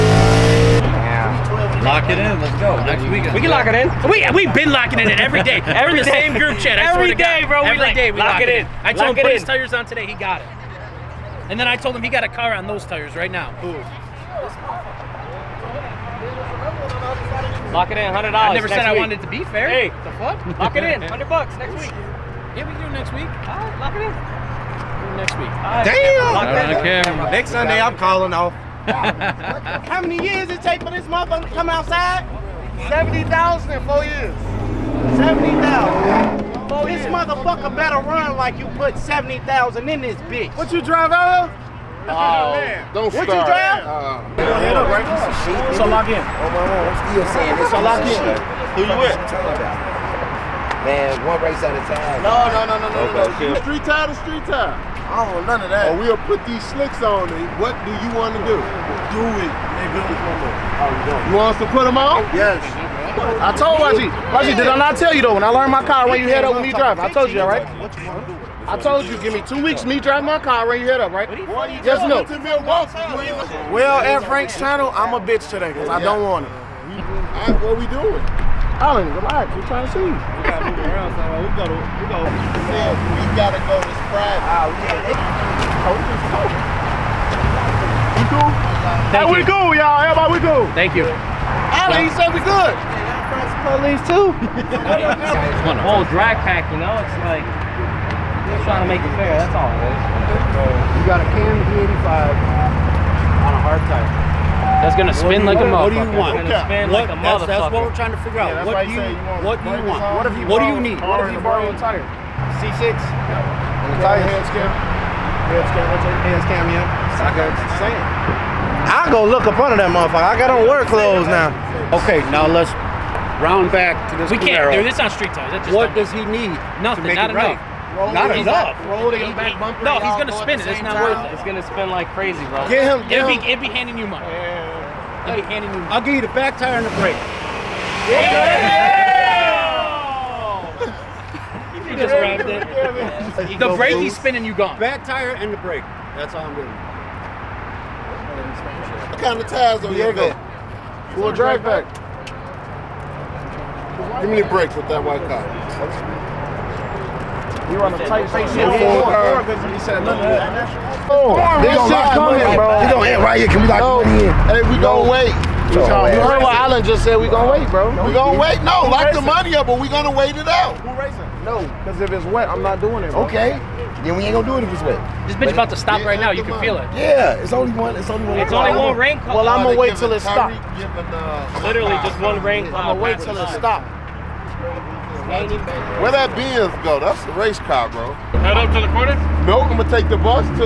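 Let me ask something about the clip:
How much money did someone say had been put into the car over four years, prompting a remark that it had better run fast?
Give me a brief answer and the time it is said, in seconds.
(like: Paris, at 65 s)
$70,000, at 32 s.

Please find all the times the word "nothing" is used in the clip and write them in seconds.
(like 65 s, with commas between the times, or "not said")
126 s, 159 s.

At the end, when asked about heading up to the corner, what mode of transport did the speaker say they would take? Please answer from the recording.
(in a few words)
the bus.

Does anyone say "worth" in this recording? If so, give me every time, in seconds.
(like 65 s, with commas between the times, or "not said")
131 s.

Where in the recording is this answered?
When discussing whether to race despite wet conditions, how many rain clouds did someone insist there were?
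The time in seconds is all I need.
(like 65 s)
178 s.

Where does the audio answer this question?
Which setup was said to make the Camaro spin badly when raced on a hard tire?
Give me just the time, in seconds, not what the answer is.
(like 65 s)
101 s.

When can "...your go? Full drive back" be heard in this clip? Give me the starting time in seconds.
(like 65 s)
149 s.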